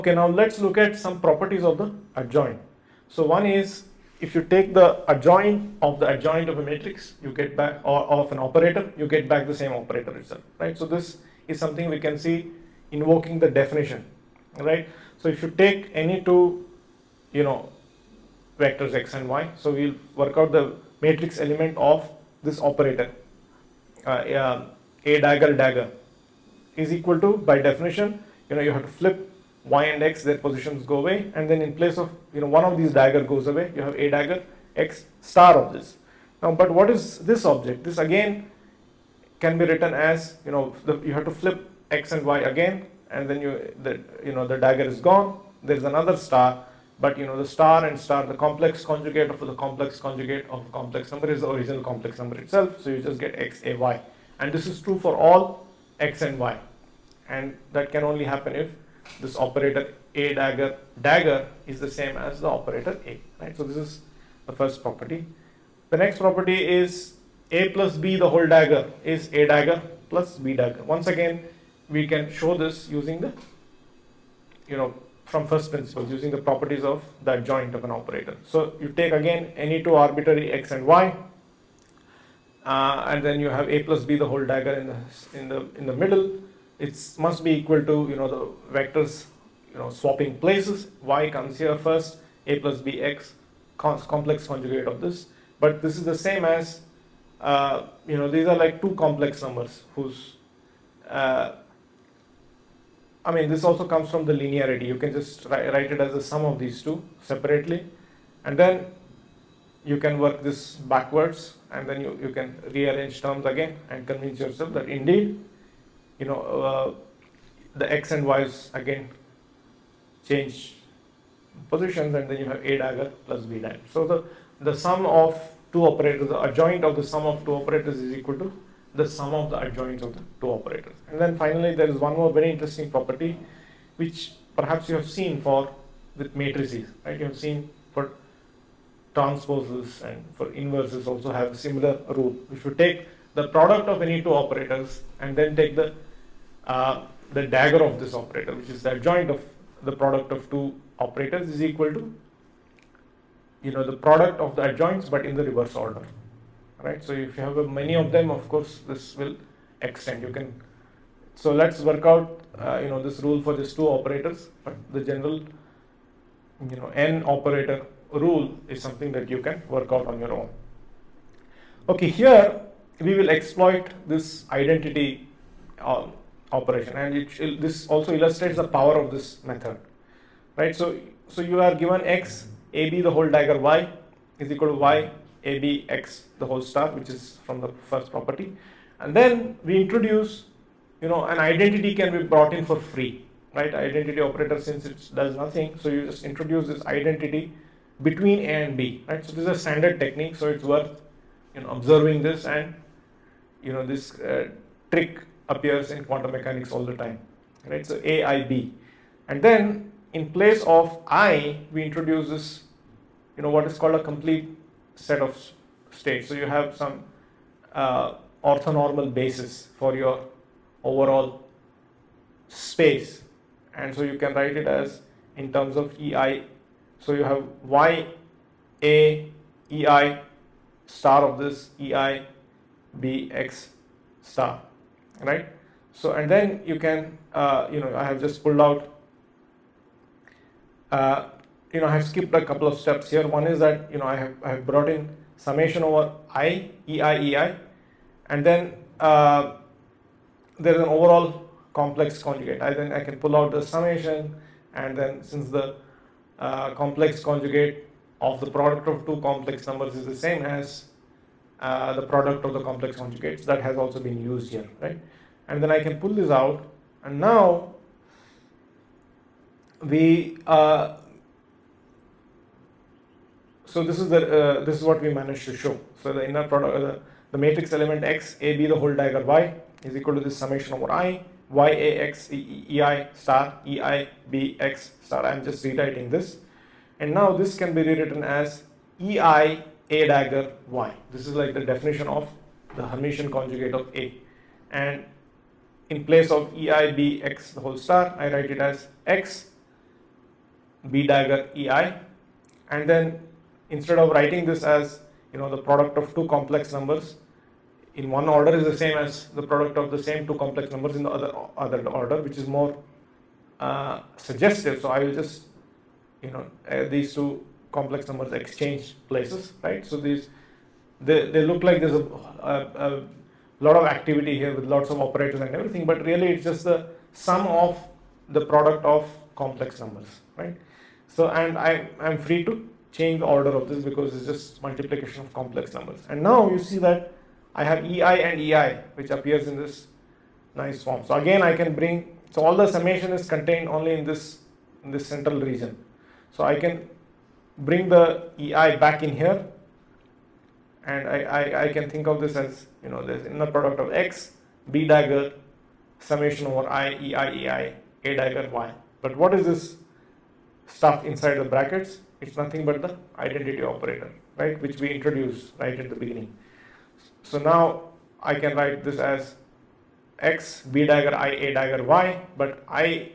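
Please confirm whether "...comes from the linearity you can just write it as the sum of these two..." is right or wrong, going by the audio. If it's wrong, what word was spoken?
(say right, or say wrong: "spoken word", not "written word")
right.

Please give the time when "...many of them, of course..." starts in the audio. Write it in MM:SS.
02:37.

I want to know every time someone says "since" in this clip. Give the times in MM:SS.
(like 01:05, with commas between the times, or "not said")
03:14, 04:15.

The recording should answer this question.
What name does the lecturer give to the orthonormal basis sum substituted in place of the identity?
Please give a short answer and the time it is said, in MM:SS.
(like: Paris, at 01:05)
Complete set of states, at 03:34.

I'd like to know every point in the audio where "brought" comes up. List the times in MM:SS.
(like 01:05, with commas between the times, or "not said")
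03:12, 04:04.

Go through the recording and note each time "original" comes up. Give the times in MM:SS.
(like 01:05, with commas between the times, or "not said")
00:51.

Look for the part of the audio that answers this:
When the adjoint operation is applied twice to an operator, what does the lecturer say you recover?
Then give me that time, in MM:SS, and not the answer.
00:09.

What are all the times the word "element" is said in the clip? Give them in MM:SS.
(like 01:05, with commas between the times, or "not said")
00:21, 04:37.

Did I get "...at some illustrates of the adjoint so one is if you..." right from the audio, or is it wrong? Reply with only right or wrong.
wrong.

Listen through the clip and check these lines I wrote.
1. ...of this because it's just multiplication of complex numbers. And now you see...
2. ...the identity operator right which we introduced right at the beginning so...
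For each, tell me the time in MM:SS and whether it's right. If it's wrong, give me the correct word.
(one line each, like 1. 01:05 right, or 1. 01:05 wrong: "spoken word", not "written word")
1. 05:33 right
2. 06:02 right.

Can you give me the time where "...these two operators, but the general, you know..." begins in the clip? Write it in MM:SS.
02:43.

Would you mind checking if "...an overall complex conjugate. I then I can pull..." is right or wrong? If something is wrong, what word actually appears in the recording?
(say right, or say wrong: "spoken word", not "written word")
right.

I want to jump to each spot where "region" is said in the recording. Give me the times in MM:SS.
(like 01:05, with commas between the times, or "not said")
05:45.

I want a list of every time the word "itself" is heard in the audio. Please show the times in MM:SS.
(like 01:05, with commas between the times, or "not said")
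00:10, 00:52.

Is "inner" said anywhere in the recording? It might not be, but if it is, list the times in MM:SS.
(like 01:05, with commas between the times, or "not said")
04:36, 05:53.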